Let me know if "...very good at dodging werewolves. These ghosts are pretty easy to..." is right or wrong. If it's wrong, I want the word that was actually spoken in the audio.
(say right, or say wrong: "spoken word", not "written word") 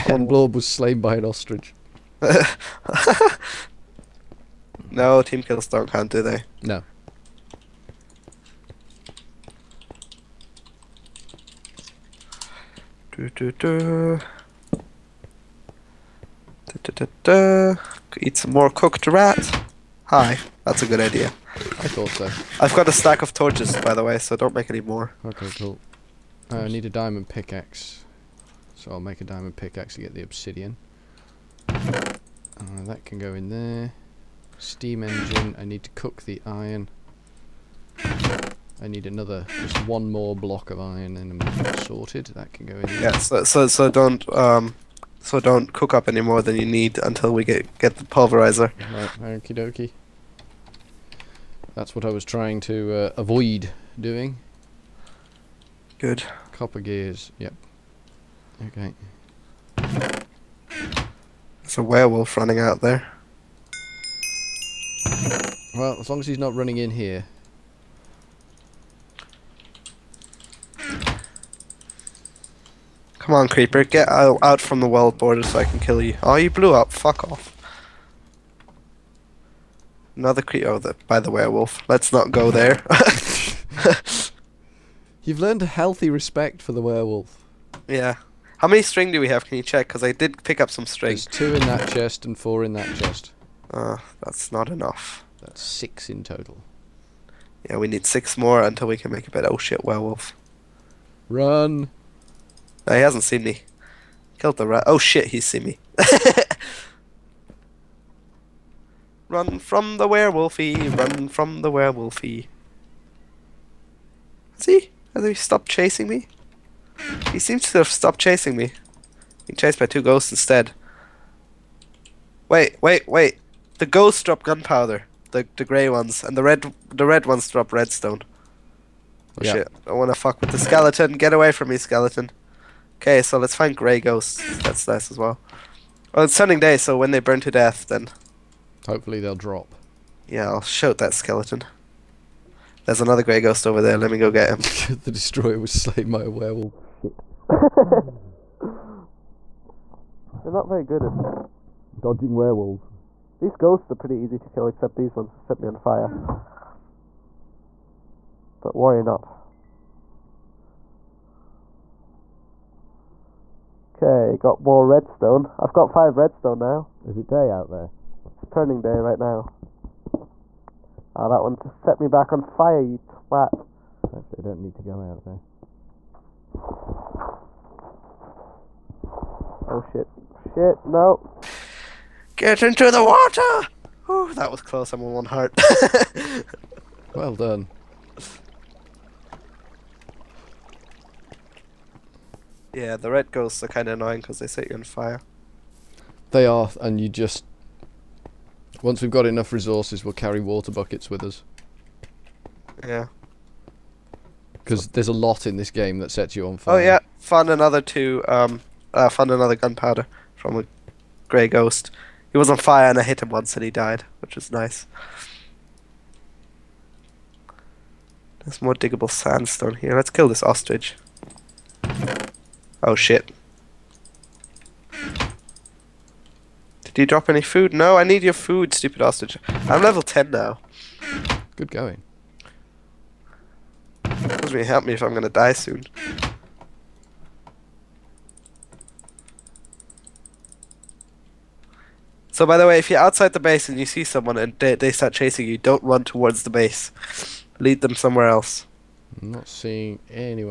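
right.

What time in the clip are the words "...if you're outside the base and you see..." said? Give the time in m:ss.
4:02.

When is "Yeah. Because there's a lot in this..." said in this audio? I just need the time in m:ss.
3:22.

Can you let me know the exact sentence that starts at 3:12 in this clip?
Yeah, the red ghosts are kind of annoying because they set you on fire.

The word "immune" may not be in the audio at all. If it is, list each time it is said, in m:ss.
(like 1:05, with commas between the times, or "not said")
not said.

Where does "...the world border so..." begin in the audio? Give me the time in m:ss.
1:14.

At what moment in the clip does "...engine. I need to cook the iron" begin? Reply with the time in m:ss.
0:35.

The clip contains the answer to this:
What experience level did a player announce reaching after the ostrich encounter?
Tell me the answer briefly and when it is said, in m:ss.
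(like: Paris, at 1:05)
10, at 3:49.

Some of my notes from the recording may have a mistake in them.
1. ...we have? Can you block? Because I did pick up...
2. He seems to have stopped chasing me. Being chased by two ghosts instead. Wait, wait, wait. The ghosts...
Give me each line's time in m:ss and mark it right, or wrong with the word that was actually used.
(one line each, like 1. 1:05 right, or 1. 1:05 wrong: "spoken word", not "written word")
1. 1:29 wrong: "check", not "block"
2. 1:57 right.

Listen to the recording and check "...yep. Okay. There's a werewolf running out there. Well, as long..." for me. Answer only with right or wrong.
right.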